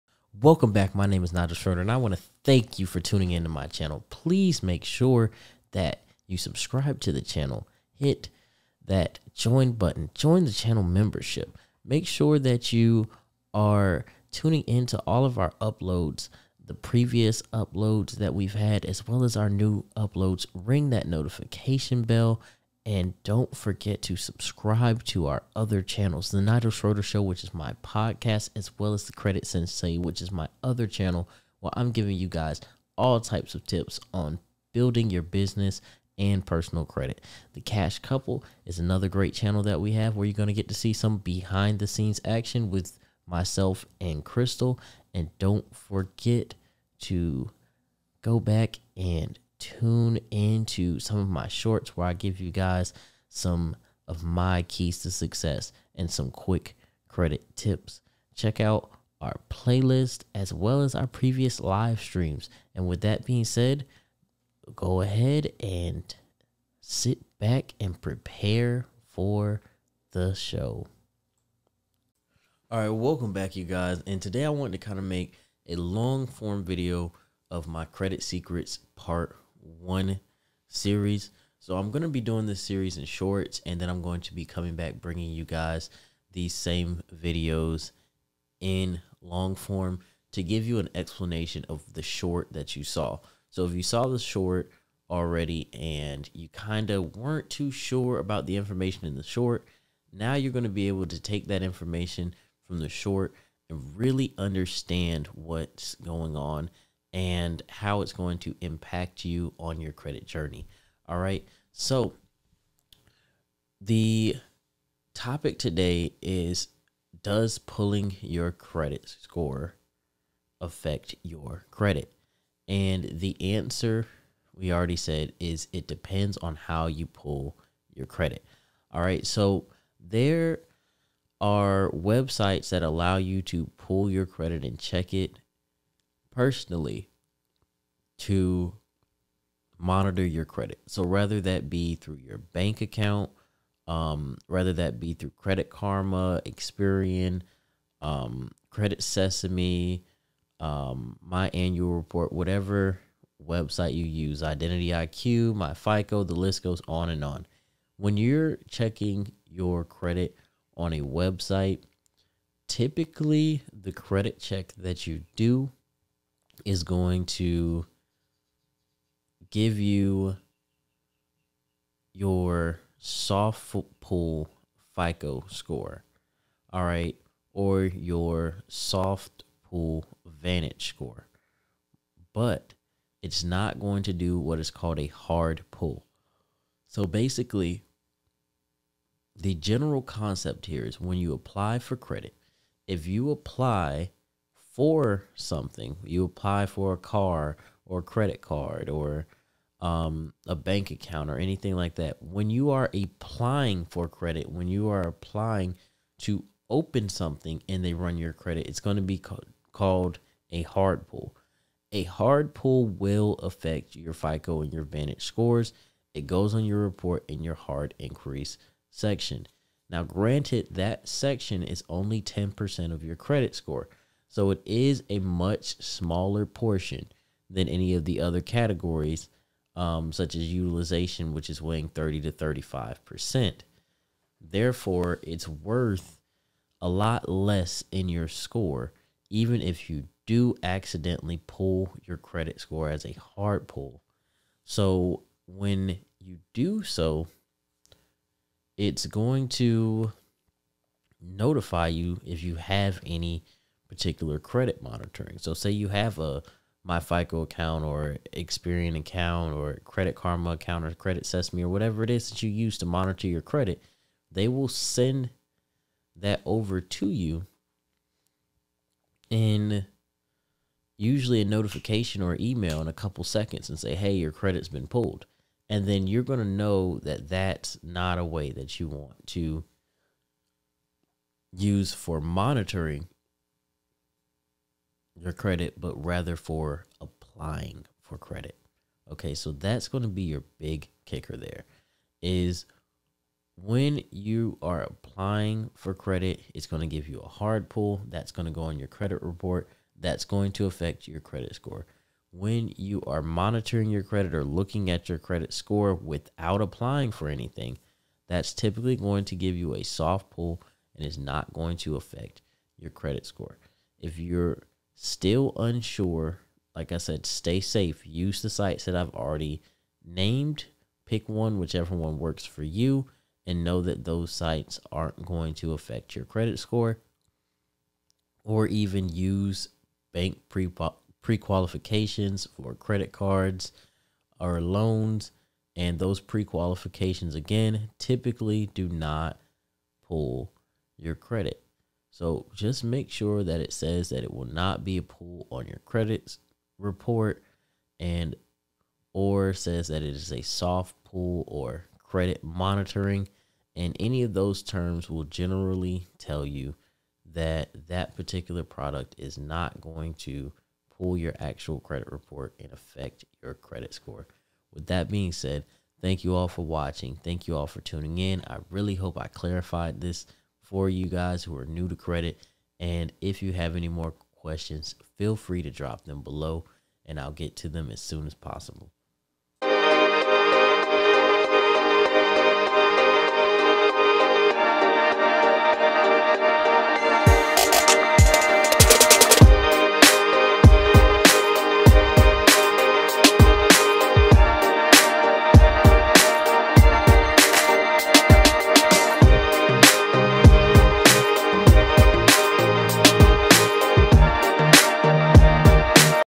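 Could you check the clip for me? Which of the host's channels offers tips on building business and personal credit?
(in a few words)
The Credit Sensei.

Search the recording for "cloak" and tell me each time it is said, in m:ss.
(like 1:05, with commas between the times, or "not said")
not said.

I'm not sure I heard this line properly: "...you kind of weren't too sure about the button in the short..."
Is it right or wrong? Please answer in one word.
wrong.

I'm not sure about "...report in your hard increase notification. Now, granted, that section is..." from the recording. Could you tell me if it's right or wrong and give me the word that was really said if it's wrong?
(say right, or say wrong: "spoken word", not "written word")
wrong: "section", not "notification".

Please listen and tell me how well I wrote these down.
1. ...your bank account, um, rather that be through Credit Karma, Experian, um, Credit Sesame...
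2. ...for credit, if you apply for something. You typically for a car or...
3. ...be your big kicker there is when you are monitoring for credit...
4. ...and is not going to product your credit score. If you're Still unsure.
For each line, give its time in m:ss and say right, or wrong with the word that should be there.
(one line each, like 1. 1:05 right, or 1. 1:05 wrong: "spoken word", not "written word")
1. 2:22 right
2. 3:11 wrong: "apply", not "typically"
3. 4:50 wrong: "applying", not "monitoring"
4. 5:10 wrong: "affect", not "product".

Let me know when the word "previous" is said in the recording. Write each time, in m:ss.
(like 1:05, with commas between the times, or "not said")
0:16, 1:01.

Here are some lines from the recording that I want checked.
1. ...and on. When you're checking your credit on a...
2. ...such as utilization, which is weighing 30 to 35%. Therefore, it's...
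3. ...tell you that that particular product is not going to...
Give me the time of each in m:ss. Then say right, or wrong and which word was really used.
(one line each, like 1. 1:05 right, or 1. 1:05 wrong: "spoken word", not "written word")
1. 2:37 right
2. 3:50 right
3. 5:56 right.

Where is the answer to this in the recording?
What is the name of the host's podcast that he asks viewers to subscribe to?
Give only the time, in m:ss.
0:26.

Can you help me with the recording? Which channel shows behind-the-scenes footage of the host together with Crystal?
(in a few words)
The Cash Couple.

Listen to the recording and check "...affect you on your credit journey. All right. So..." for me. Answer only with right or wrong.
wrong.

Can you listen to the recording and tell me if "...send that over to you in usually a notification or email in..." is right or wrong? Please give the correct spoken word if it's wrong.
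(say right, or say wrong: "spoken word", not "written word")
right.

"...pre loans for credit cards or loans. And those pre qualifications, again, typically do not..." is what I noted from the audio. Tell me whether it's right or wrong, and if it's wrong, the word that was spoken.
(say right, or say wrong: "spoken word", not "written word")
wrong: "qualifications", not "loans".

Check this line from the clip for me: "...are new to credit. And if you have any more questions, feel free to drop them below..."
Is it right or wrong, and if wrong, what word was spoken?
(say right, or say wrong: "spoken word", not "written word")
right.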